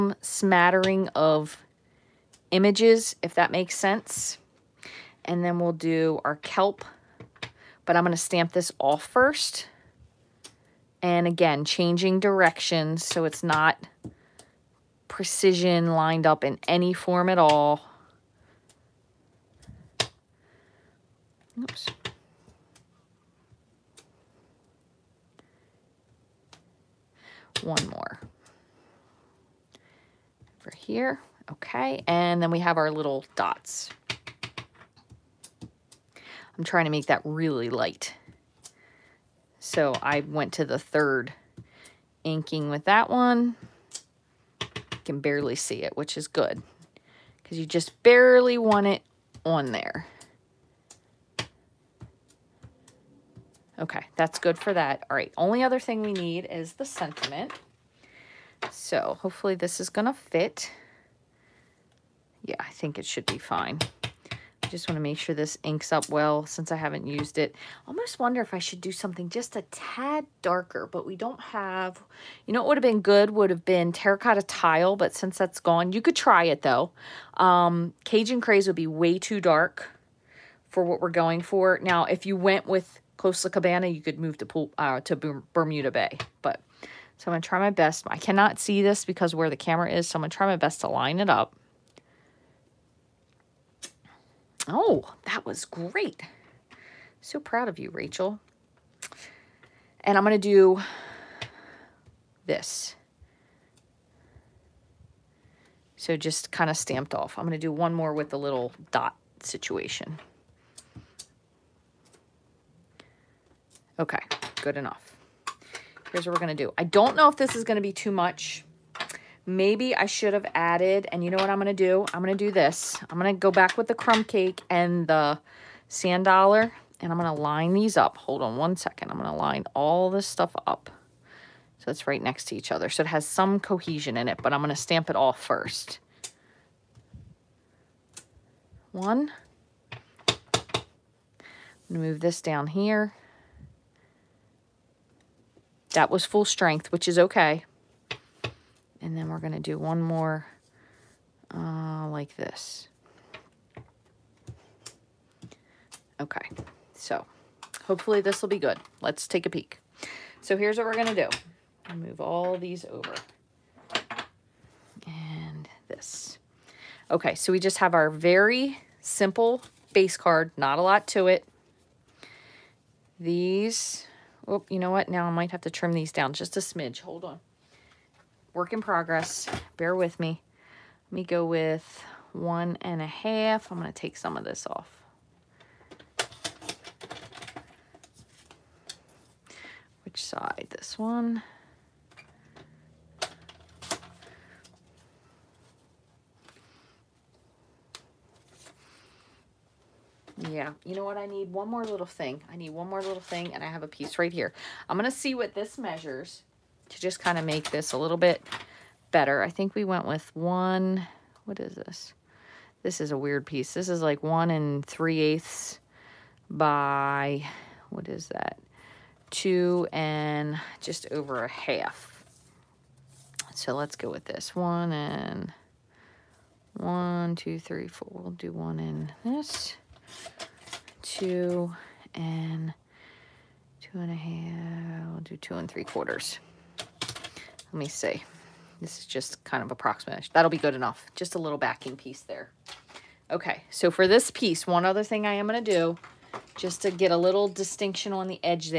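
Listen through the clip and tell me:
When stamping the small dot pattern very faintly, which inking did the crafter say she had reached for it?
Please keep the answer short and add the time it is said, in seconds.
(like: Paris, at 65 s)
third inking, at 40 s.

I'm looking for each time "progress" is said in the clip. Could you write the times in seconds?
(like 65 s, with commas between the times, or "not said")
178 s.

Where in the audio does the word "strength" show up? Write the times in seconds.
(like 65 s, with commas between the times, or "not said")
146 s.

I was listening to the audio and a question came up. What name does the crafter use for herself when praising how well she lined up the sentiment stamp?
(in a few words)
Rachael.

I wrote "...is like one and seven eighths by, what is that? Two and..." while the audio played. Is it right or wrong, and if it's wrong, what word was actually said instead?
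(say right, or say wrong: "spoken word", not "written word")
wrong: "three", not "seven".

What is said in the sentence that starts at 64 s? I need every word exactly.
Just want to make sure this inks up well since I haven't used it.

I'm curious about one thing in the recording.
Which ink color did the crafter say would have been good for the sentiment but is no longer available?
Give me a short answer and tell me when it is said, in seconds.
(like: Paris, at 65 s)
Terracotta Tile, at 73 s.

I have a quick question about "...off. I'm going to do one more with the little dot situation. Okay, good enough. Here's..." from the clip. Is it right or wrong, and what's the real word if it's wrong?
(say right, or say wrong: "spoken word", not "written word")
right.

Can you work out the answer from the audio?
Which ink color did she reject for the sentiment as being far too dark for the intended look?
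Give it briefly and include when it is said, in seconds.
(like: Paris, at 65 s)
Cajun Craze, at 78 s.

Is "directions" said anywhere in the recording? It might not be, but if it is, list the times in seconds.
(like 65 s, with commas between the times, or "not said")
12 s.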